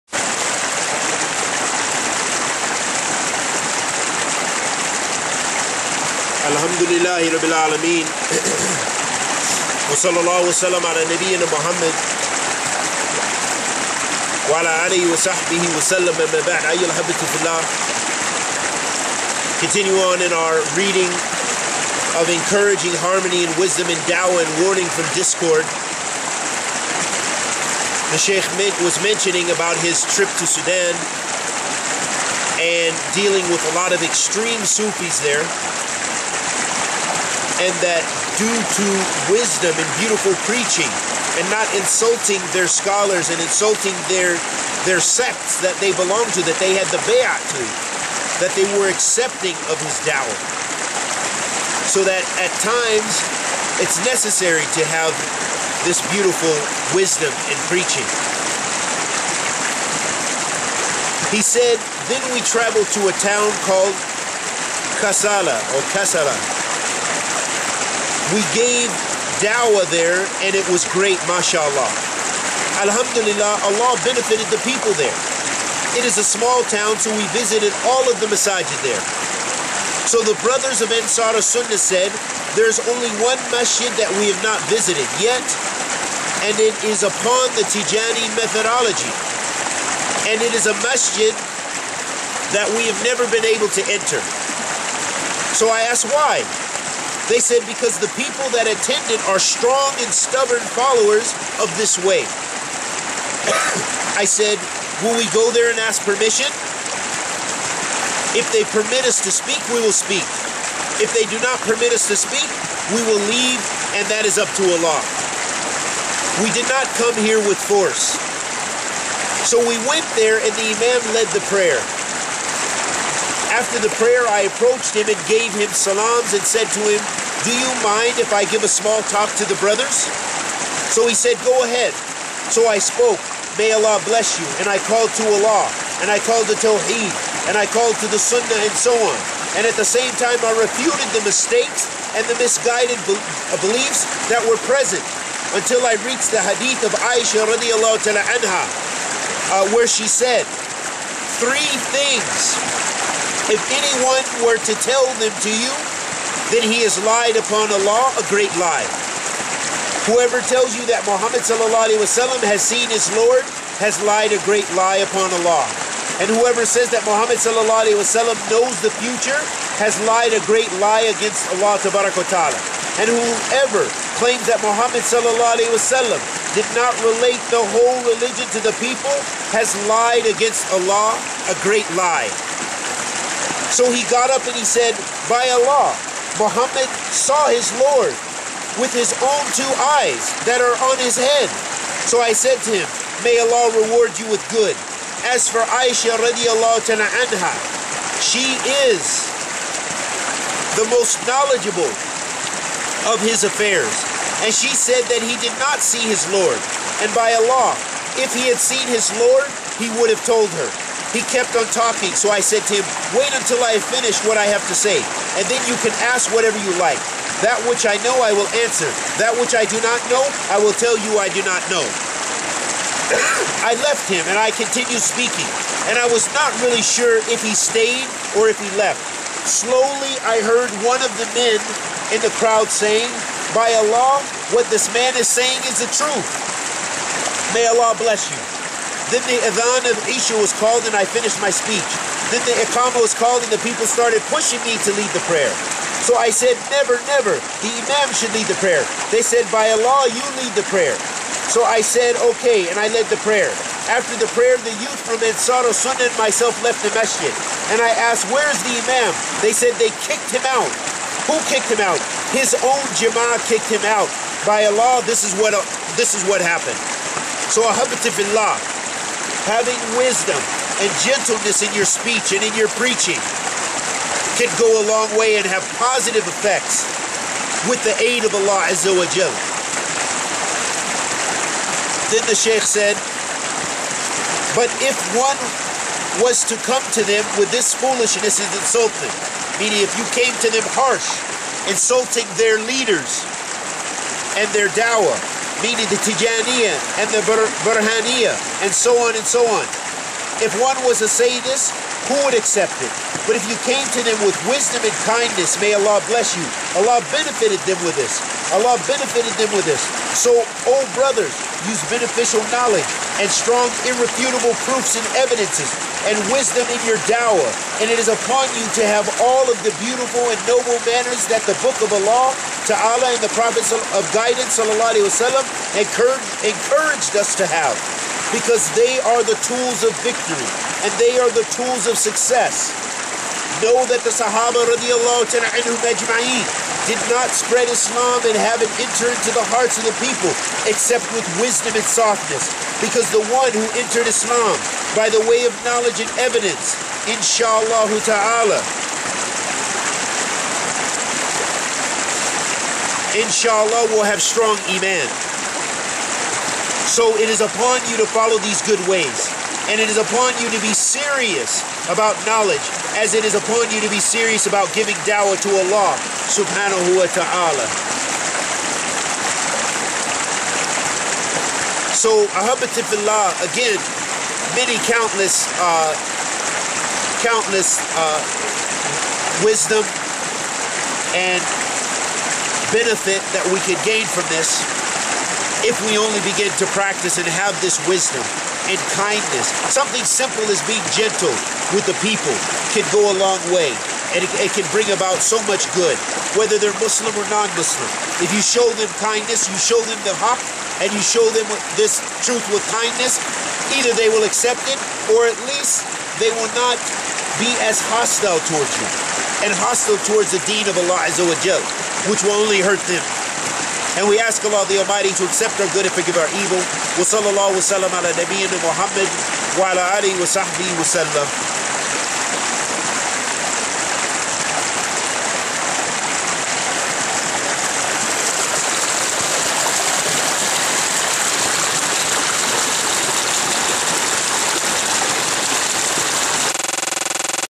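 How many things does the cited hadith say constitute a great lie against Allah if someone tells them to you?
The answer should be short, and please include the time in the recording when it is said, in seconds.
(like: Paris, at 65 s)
3, at 151 s.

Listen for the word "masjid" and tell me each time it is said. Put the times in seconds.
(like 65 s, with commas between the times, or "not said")
83 s, 90 s, 256 s.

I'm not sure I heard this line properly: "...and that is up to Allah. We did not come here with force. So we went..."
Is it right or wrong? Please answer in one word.
right.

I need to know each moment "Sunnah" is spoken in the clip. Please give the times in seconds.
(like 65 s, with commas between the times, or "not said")
81 s, 138 s, 255 s.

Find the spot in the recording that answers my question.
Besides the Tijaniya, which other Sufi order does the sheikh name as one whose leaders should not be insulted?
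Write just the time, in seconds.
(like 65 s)
297 s.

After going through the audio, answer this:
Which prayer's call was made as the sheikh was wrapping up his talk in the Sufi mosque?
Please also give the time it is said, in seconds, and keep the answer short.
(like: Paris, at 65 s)
Isha, at 240 s.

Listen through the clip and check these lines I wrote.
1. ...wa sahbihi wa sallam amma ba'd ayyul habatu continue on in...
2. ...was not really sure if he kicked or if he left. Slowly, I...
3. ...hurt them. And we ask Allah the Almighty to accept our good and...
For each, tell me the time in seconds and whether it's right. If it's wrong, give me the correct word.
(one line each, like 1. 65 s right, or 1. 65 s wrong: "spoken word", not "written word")
1. 15 s right
2. 226 s wrong: "stayed", not "kicked"
3. 412 s right.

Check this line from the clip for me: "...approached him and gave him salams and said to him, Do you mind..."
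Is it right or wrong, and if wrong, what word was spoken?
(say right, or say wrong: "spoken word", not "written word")
right.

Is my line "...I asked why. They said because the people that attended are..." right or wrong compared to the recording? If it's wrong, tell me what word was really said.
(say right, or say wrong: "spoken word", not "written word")
right.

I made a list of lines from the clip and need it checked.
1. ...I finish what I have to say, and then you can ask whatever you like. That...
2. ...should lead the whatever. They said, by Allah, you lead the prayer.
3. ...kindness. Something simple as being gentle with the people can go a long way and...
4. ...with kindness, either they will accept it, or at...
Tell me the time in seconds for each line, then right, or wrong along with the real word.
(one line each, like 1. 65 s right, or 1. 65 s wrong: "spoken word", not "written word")
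1. 213 s right
2. 248 s wrong: "prayer", not "whatever"
3. 388 s right
4. 402 s right.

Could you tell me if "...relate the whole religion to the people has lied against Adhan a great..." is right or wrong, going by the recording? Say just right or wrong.
wrong.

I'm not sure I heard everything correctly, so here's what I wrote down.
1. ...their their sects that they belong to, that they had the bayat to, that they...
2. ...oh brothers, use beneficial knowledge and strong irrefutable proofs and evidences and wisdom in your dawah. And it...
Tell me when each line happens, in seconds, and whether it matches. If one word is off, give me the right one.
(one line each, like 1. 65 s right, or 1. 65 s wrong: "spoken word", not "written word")
1. 44 s right
2. 310 s right.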